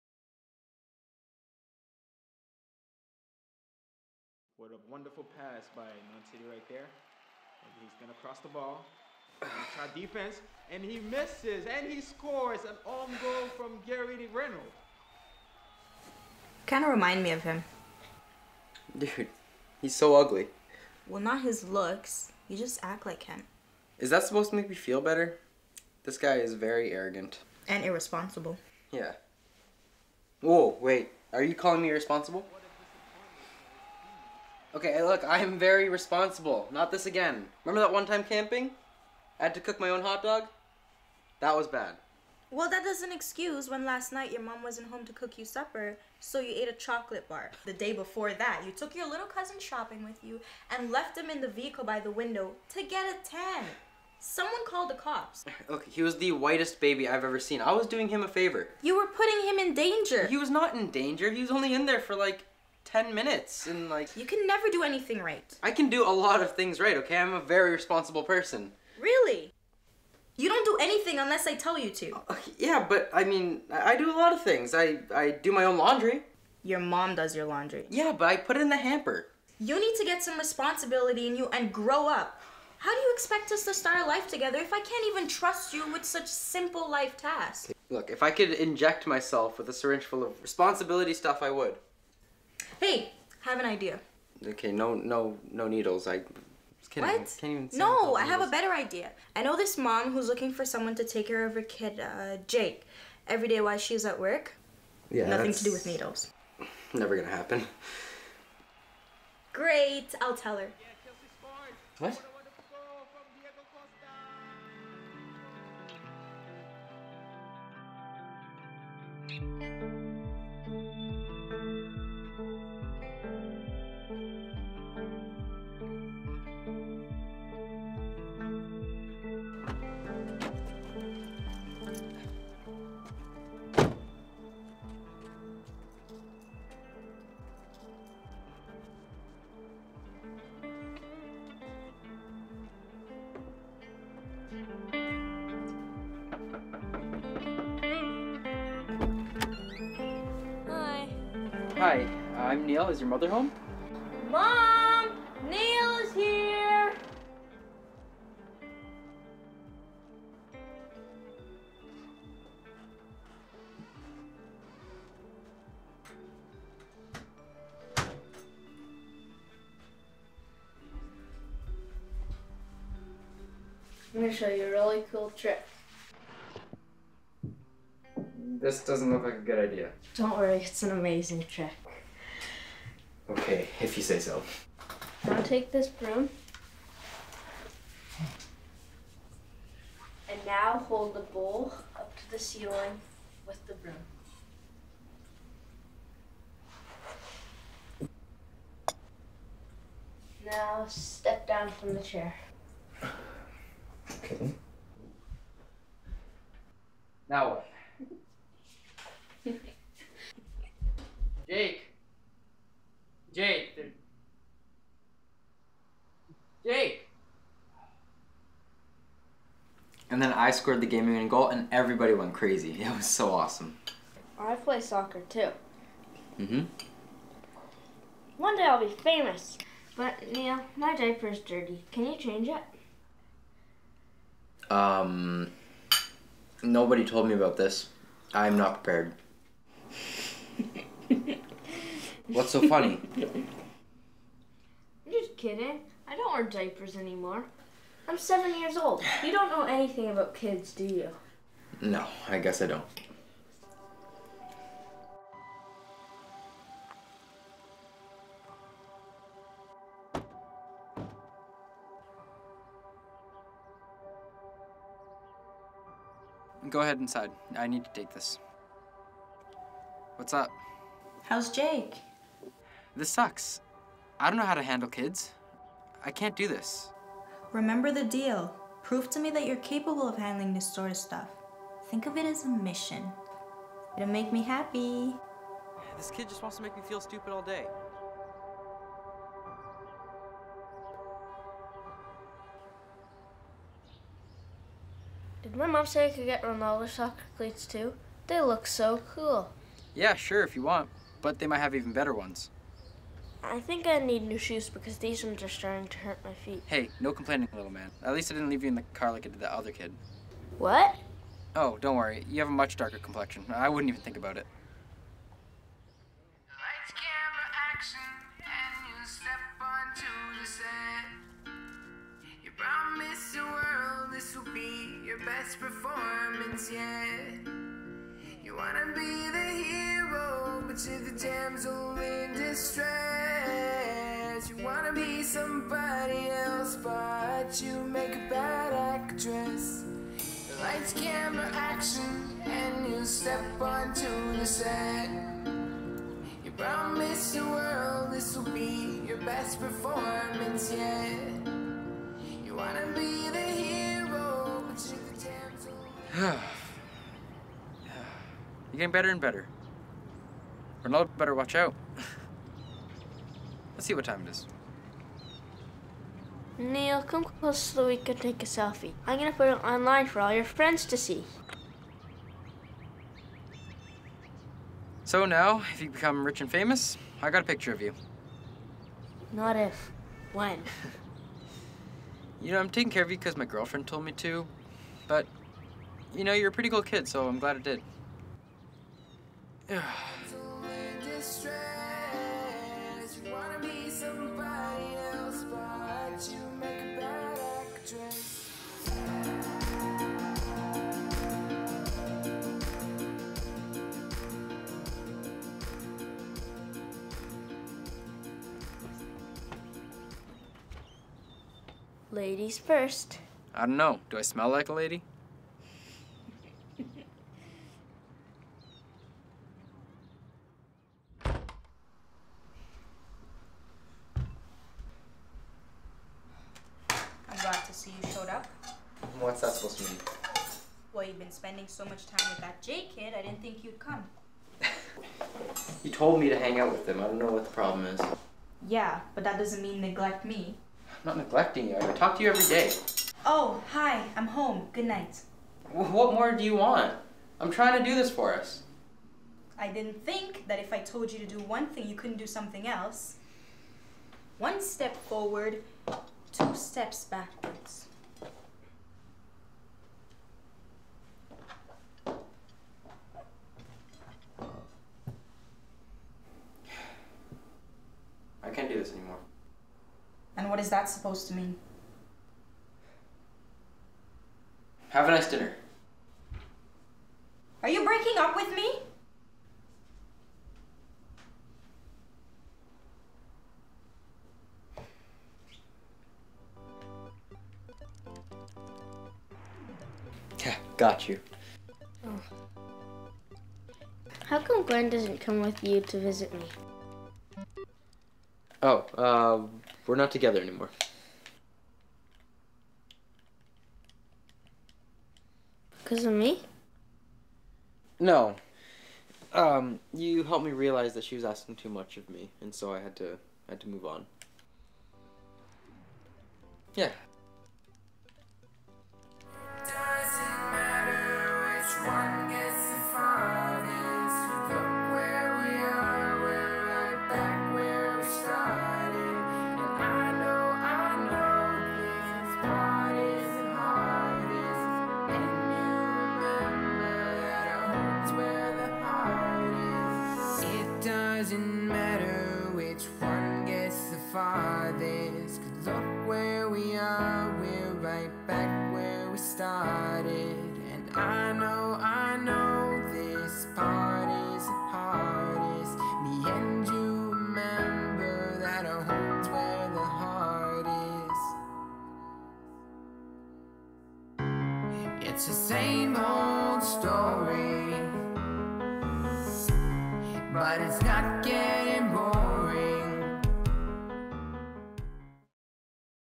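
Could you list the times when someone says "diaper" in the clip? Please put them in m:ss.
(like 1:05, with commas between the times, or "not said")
3:50, 4:06.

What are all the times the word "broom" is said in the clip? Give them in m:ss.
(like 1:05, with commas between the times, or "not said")
3:05, 3:13.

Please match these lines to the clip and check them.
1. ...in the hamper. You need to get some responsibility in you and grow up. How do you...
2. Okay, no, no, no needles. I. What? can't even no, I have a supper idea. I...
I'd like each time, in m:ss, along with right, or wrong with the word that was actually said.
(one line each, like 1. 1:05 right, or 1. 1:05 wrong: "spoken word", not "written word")
1. 1:18 right
2. 1:34 wrong: "better", not "supper".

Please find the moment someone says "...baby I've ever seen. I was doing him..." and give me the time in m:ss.
0:56.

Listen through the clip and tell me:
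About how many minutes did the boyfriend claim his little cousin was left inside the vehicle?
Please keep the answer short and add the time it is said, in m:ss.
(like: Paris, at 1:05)
10, at 1:02.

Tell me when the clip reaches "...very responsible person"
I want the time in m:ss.
1:07.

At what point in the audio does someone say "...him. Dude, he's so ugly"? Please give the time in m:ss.
0:17.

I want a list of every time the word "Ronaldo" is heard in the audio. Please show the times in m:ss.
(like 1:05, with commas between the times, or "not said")
4:56, 6:00.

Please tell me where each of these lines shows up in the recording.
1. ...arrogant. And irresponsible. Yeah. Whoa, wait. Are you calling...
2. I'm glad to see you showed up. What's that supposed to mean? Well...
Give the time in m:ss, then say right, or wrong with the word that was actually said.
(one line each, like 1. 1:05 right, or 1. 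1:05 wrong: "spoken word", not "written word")
1. 0:26 right
2. 7:01 right.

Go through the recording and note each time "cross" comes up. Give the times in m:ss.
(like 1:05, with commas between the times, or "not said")
0:08.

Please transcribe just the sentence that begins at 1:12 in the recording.
Uh, uh yeah, but I mean, I do a lot of things.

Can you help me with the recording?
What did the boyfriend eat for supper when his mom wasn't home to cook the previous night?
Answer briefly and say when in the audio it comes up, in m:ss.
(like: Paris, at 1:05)
a chocolate bar, at 0:46.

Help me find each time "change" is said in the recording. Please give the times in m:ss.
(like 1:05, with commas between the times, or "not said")
3:52.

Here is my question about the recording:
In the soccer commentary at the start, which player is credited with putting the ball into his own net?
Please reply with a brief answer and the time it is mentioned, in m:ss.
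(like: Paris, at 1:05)
Gary Reynolds, at 0:13.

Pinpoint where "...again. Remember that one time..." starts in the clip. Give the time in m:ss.
0:37.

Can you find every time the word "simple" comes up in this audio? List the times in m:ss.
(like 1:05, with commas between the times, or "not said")
1:26.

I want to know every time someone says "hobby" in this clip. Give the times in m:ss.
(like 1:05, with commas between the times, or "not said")
not said.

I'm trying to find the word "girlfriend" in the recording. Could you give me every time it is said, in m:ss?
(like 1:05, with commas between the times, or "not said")
6:23.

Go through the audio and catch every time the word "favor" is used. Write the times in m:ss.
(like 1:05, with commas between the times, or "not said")
0:58.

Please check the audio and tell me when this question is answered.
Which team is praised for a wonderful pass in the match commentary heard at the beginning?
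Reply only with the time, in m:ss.
0:05.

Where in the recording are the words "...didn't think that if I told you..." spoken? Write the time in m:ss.
7:29.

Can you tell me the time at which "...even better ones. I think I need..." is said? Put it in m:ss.
5:01.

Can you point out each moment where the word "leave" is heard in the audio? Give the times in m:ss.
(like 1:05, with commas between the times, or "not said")
5:08.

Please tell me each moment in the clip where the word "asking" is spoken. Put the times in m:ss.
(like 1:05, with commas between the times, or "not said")
8:31.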